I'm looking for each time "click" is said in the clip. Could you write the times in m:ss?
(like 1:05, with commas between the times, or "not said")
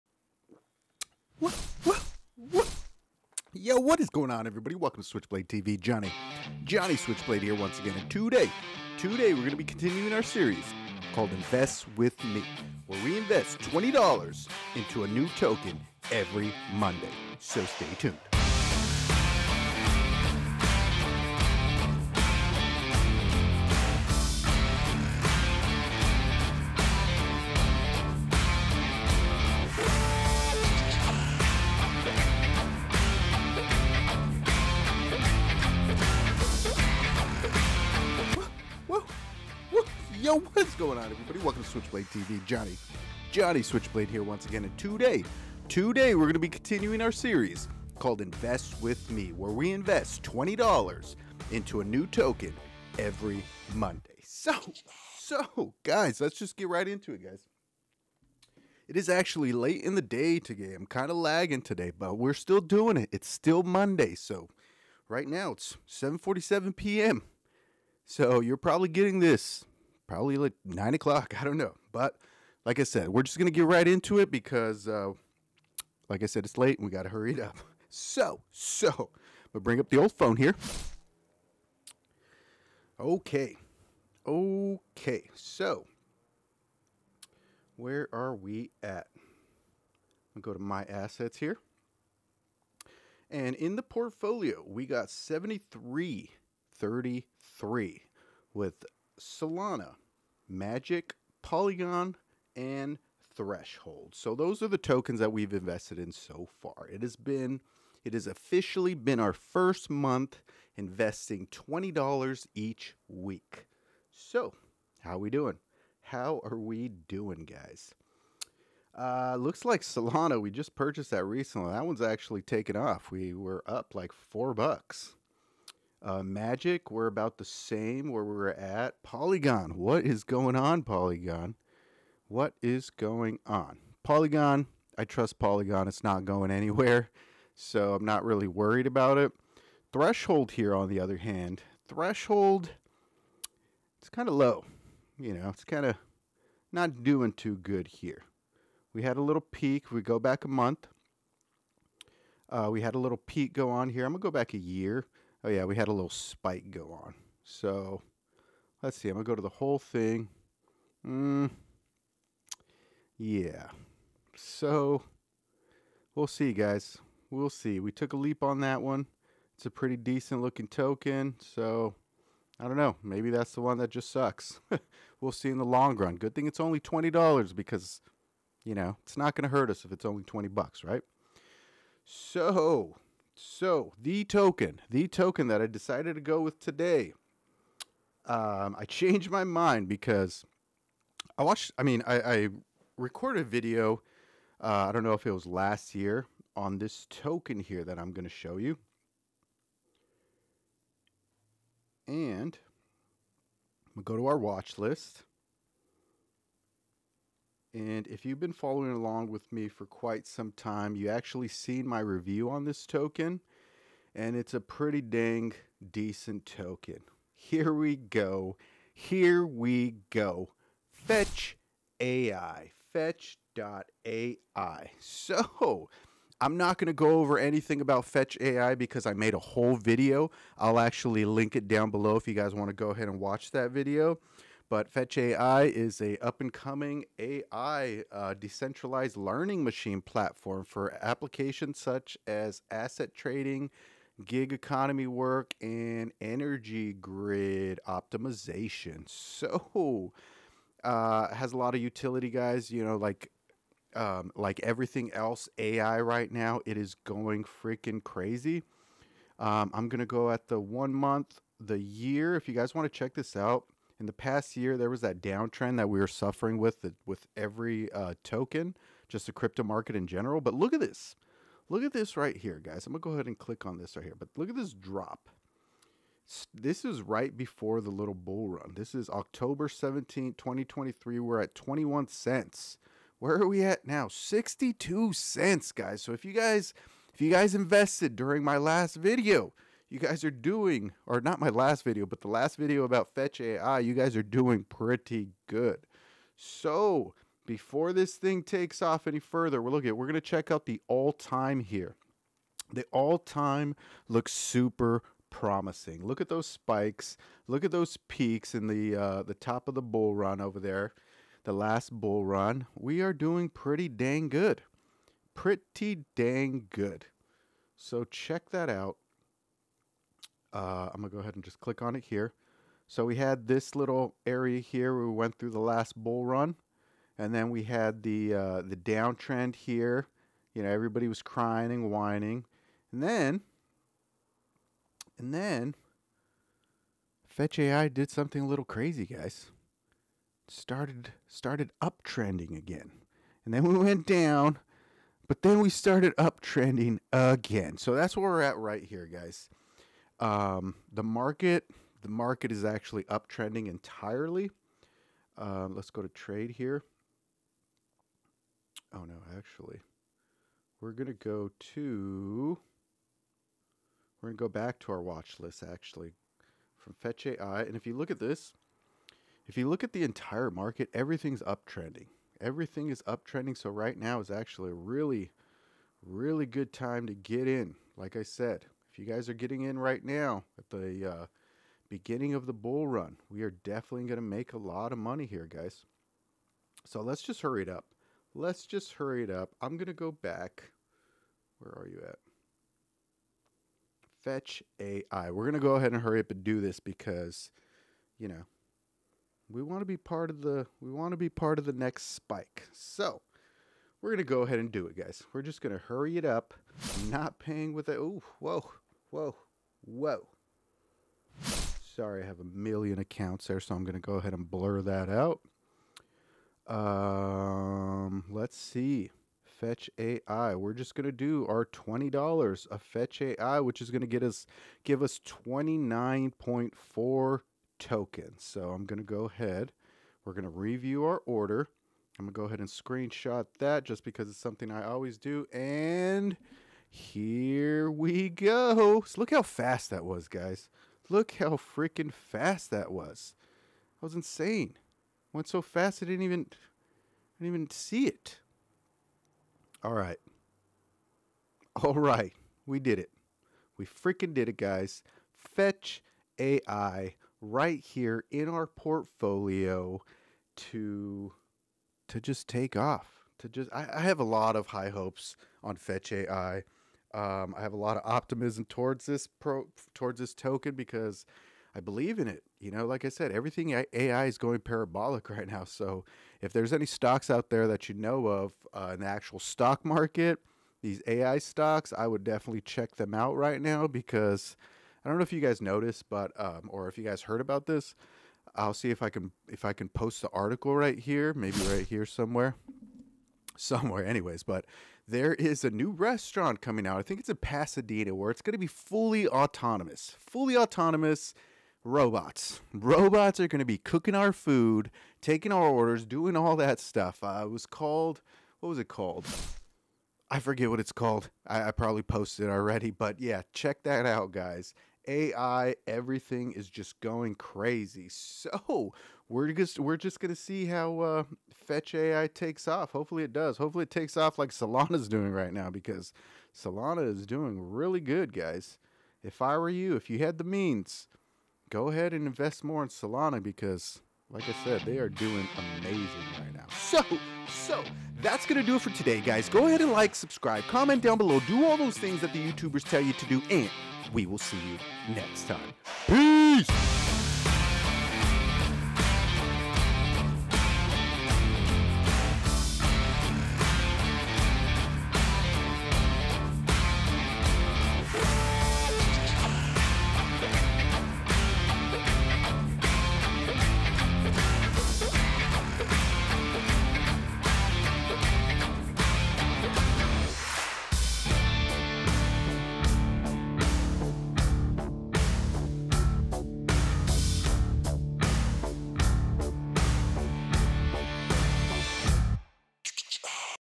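4:33, 5:21.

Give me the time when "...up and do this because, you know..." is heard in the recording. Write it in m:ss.
6:36.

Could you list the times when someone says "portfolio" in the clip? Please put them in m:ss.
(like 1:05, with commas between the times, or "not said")
1:33, 7:38.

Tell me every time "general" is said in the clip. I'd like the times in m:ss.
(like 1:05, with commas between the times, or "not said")
4:30.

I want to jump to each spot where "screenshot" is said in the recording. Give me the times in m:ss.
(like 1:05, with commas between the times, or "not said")
7:12.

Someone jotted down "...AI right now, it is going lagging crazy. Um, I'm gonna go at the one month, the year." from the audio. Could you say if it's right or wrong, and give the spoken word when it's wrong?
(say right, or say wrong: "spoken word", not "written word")
wrong: "freaking", not "lagging".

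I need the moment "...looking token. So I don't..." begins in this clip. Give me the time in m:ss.
2:50.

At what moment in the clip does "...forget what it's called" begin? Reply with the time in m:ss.
8:30.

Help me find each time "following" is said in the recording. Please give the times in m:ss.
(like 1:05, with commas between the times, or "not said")
3:28.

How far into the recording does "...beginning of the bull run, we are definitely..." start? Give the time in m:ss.
6:21.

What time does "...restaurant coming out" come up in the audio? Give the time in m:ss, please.
8:15.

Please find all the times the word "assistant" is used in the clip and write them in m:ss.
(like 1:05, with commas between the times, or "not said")
not said.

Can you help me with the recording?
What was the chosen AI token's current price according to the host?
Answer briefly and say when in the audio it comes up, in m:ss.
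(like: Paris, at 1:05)
62 cents, at 4:44.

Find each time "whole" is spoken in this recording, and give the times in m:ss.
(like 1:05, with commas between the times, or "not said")
2:39, 3:49.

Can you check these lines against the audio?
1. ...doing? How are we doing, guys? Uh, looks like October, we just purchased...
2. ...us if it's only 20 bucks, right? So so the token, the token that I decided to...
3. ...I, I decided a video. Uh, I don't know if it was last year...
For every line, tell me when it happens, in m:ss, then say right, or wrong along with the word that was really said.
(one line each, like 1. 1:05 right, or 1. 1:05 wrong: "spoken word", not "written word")
1. 1:55 wrong: "Solana", not "October"
2. 2:59 right
3. 3:12 wrong: "recorded", not "decided".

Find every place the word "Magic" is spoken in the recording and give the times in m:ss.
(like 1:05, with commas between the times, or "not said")
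1:40, 2:06.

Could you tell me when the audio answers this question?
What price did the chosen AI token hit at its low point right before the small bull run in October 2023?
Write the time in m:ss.
4:41.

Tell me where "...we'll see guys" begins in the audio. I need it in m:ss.
2:46.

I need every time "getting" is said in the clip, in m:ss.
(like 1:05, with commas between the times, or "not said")
1:08, 6:19.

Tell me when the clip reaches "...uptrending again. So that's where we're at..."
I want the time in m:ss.
5:46.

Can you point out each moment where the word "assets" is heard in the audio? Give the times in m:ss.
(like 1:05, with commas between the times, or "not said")
1:30, 4:02.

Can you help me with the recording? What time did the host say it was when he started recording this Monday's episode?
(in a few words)
7:47 p.m.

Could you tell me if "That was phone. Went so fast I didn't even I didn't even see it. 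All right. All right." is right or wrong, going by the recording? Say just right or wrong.
wrong.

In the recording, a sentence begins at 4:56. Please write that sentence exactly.
So before this thing takes off any further, we're looking we're going to check out the all time here.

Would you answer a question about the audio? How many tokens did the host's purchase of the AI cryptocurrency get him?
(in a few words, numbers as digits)
29.4.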